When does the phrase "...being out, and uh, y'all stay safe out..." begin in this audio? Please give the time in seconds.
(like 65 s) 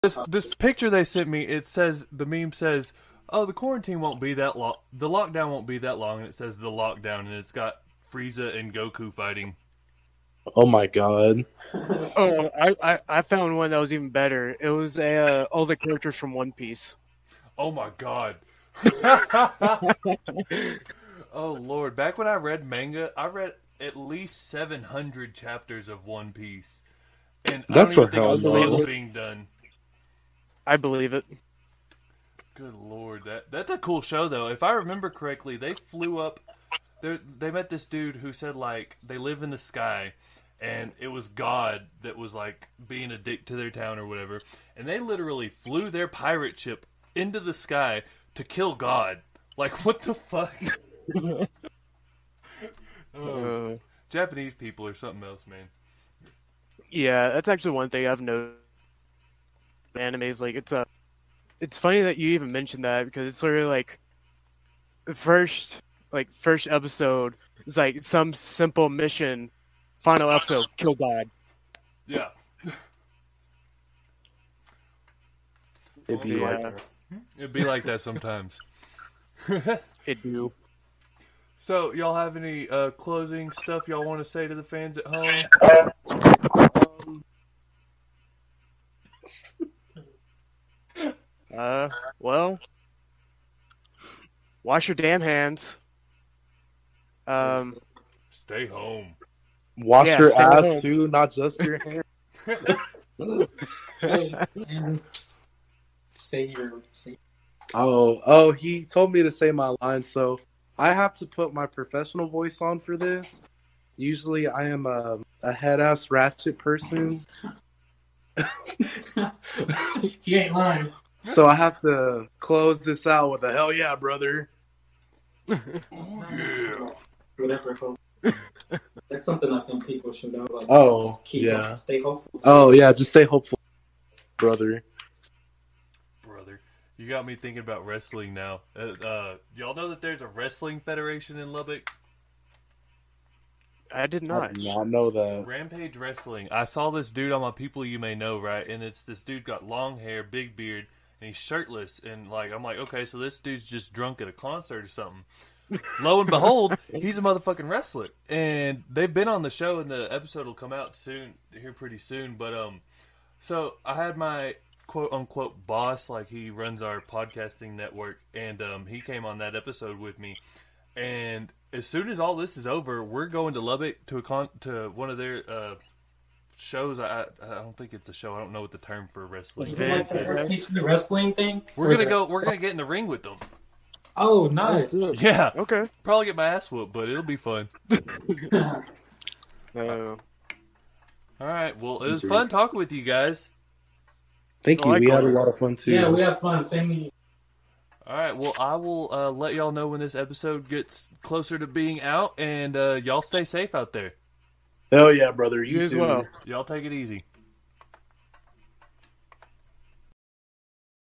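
201 s.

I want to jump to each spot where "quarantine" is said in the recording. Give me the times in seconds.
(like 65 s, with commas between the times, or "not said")
3 s.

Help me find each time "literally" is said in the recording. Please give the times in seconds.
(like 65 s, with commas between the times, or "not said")
44 s, 63 s.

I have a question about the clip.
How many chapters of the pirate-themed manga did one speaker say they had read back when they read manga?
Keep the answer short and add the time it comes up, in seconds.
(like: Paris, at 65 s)
700, at 24 s.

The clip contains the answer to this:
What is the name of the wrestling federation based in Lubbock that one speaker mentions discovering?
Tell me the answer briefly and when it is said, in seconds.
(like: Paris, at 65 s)
Rampage Wrestling, at 145 s.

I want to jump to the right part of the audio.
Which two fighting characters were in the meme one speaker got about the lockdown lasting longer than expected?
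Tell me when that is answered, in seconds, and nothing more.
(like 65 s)
8 s.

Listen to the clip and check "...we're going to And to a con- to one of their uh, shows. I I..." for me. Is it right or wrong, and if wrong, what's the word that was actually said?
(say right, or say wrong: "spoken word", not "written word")
wrong: "Lubbock", not "And".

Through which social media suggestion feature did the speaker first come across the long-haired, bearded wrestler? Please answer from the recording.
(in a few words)
People You May Know.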